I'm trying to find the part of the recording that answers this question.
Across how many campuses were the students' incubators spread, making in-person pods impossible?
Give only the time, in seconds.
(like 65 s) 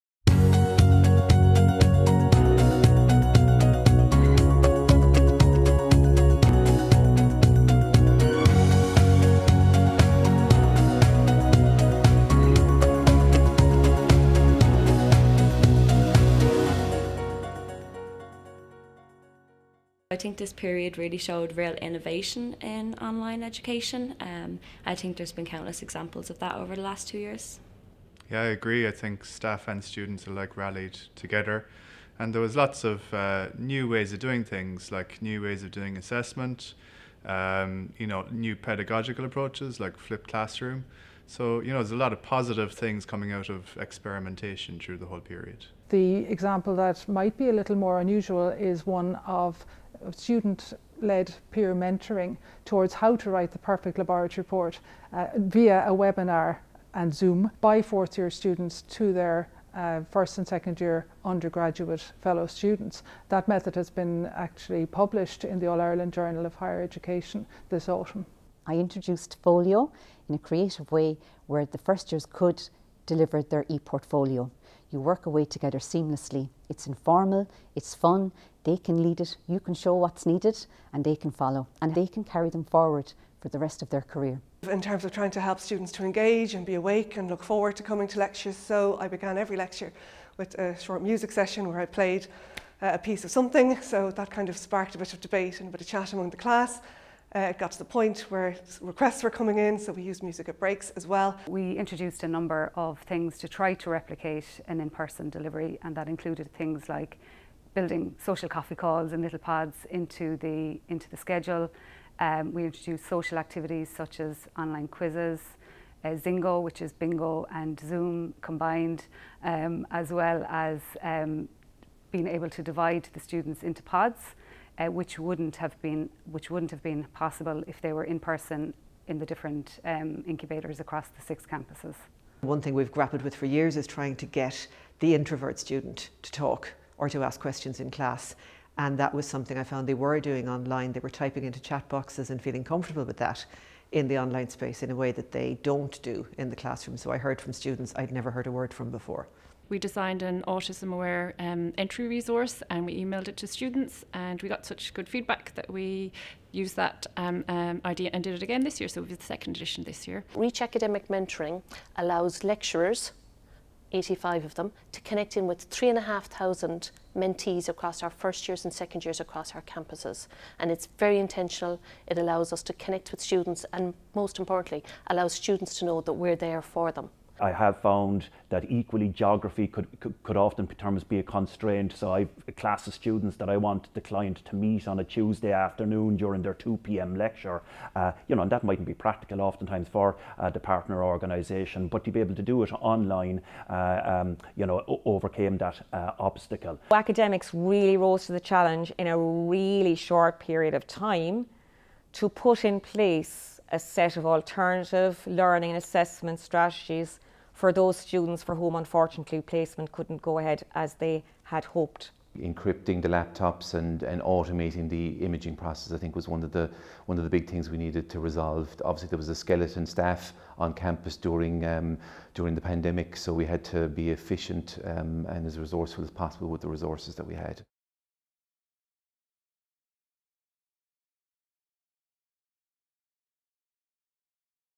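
131 s.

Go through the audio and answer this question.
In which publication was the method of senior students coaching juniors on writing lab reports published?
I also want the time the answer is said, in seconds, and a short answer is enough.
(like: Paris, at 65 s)
All Ireland Journal of Higher Education, at 65 s.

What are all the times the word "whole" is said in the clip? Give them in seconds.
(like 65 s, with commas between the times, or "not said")
45 s.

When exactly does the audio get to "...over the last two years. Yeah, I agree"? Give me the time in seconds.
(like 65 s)
26 s.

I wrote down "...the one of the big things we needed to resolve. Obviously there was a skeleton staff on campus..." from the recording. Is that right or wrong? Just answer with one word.
right.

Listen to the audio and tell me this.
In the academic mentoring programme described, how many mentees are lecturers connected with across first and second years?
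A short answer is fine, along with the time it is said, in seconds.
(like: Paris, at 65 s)
3,500, at 165 s.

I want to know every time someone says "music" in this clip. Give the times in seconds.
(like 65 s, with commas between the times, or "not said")
91 s, 100 s.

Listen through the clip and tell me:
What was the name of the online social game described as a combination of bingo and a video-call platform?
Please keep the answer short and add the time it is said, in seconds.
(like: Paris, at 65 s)
Zingo, at 116 s.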